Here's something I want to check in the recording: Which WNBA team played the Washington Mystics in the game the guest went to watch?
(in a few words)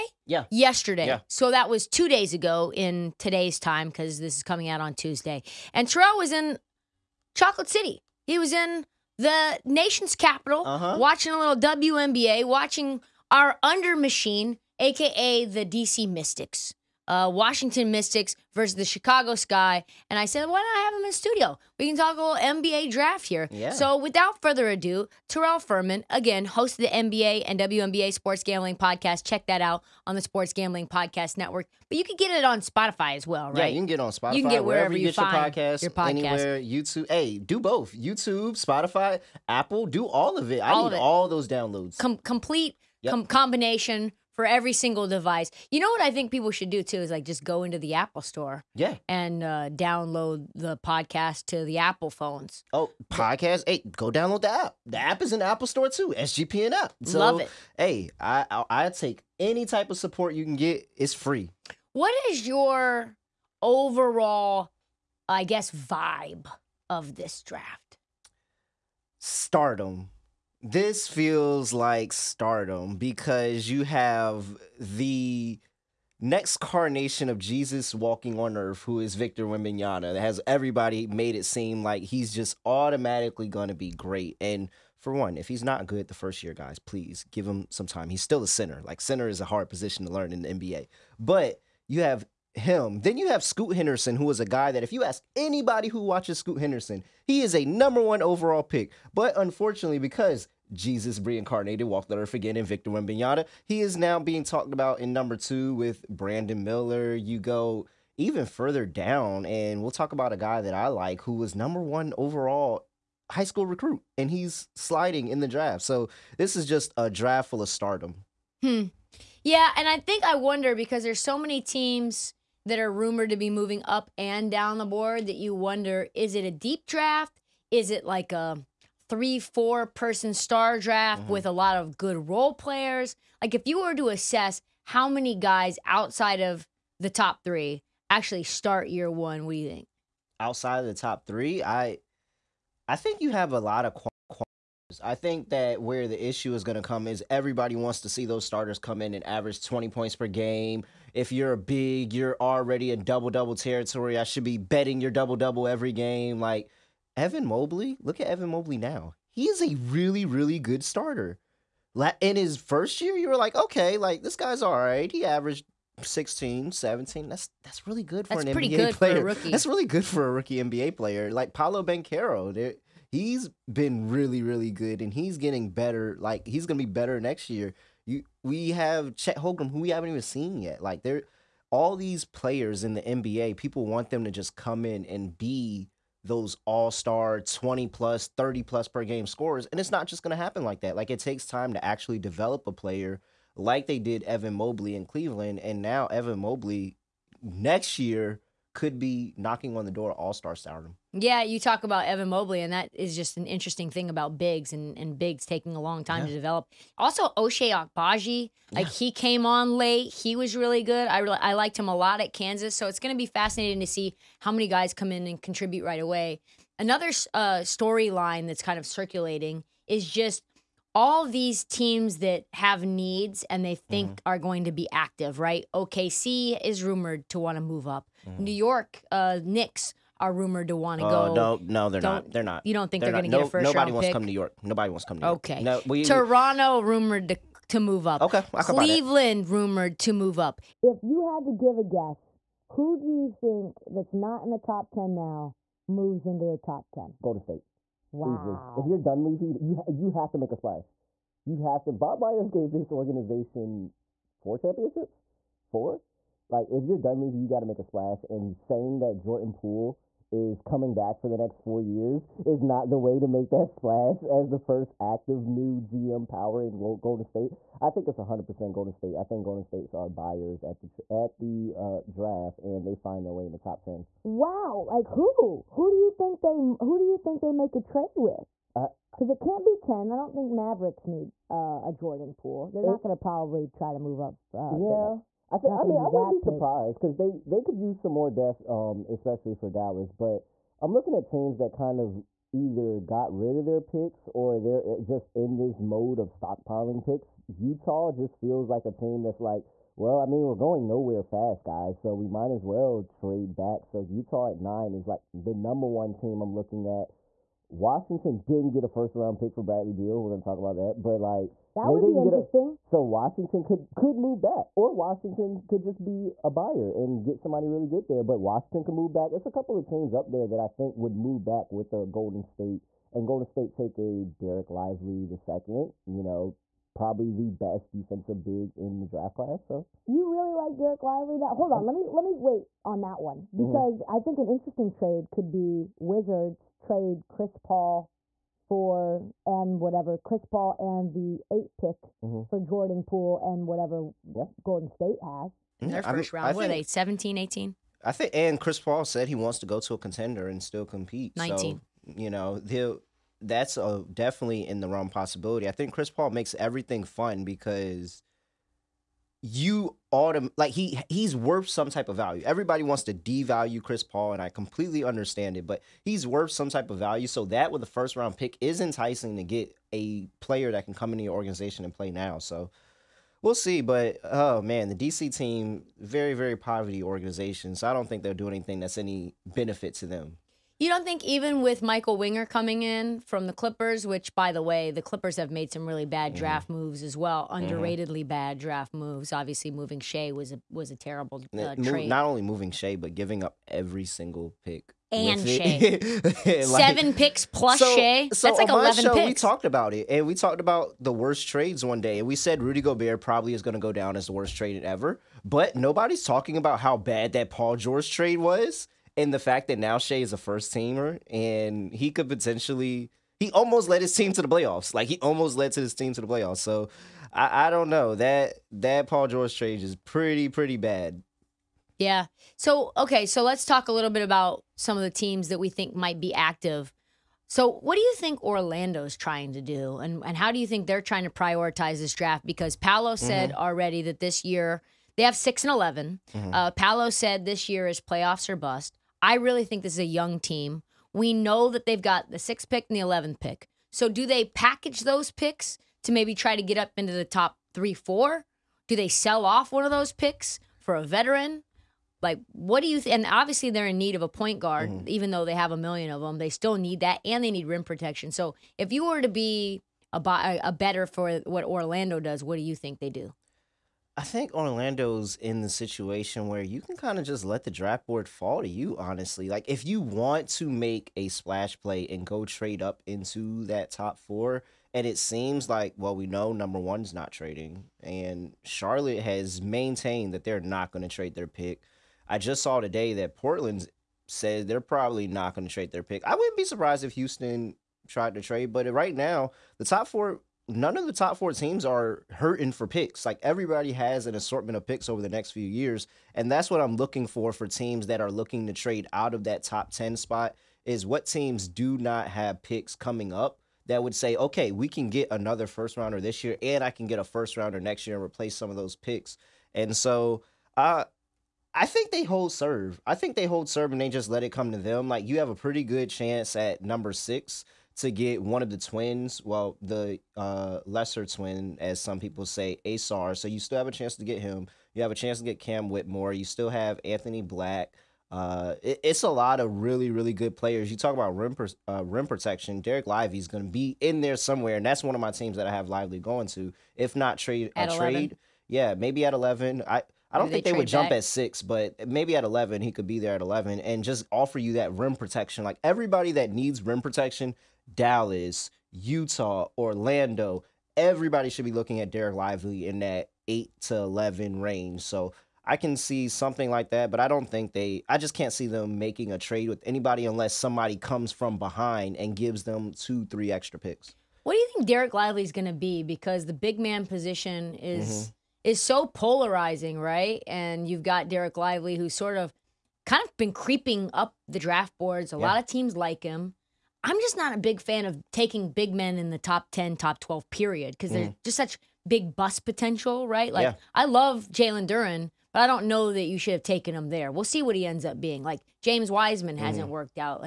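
Chicago Sky.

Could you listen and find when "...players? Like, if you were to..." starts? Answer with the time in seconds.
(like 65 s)
132 s.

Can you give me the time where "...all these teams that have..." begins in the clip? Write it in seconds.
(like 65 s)
220 s.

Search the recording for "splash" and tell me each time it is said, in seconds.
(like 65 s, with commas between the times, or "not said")
250 s, 257 s, 263 s, 471 s.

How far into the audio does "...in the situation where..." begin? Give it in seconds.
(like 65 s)
465 s.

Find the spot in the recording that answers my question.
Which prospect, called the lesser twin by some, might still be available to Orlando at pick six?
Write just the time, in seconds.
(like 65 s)
522 s.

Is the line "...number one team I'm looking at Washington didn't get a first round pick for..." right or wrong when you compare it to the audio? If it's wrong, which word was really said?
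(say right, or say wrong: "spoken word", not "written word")
right.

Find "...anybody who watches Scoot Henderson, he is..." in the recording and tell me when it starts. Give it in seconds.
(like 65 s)
95 s.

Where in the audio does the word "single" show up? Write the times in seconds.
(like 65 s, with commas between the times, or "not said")
44 s, 394 s.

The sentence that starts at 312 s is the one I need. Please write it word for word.
A, so Washington could could move back, or Washington could just be a buyer and get somebody really good there.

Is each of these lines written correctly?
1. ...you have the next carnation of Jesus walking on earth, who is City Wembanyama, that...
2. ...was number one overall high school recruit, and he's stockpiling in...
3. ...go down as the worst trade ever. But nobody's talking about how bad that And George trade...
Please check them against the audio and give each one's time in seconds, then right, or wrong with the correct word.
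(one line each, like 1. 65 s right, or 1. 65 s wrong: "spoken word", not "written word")
1. 73 s wrong: "Victor", not "City"
2. 111 s wrong: "sliding", not "stockpiling"
3. 403 s wrong: "Paul", not "And".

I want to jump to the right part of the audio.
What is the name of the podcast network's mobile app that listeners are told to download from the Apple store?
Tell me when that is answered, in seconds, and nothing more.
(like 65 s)
56 s.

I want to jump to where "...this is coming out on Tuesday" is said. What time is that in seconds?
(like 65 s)
4 s.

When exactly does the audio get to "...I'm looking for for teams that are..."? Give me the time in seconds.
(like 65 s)
496 s.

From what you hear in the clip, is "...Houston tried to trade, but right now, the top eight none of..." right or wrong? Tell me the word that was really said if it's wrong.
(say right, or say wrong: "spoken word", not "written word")
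wrong: "four", not "eight".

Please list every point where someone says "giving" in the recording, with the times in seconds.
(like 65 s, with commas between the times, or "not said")
393 s.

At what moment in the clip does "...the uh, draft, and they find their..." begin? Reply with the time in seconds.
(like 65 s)
271 s.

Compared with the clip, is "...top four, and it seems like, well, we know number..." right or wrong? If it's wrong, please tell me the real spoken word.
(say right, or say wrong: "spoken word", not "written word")
right.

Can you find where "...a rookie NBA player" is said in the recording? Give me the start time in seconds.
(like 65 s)
170 s.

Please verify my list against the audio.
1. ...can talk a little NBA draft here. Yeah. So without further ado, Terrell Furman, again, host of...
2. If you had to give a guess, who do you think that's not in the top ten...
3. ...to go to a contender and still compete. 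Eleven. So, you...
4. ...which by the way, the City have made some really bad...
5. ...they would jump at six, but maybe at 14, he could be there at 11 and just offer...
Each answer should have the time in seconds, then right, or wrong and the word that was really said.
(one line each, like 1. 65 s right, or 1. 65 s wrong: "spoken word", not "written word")
1. 21 s right
2. 240 s right
3. 349 s wrong: "Nineteen", not "Eleven"
4. 384 s wrong: "Clippers", not "City"
5. 540 s wrong: "11", not "14".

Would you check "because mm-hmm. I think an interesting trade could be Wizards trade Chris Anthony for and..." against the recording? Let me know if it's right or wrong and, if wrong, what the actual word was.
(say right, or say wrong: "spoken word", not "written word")
wrong: "Paul", not "Anthony".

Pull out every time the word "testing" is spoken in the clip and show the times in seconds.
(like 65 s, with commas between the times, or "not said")
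not said.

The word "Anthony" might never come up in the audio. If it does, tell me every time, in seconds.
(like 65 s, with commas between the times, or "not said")
527 s.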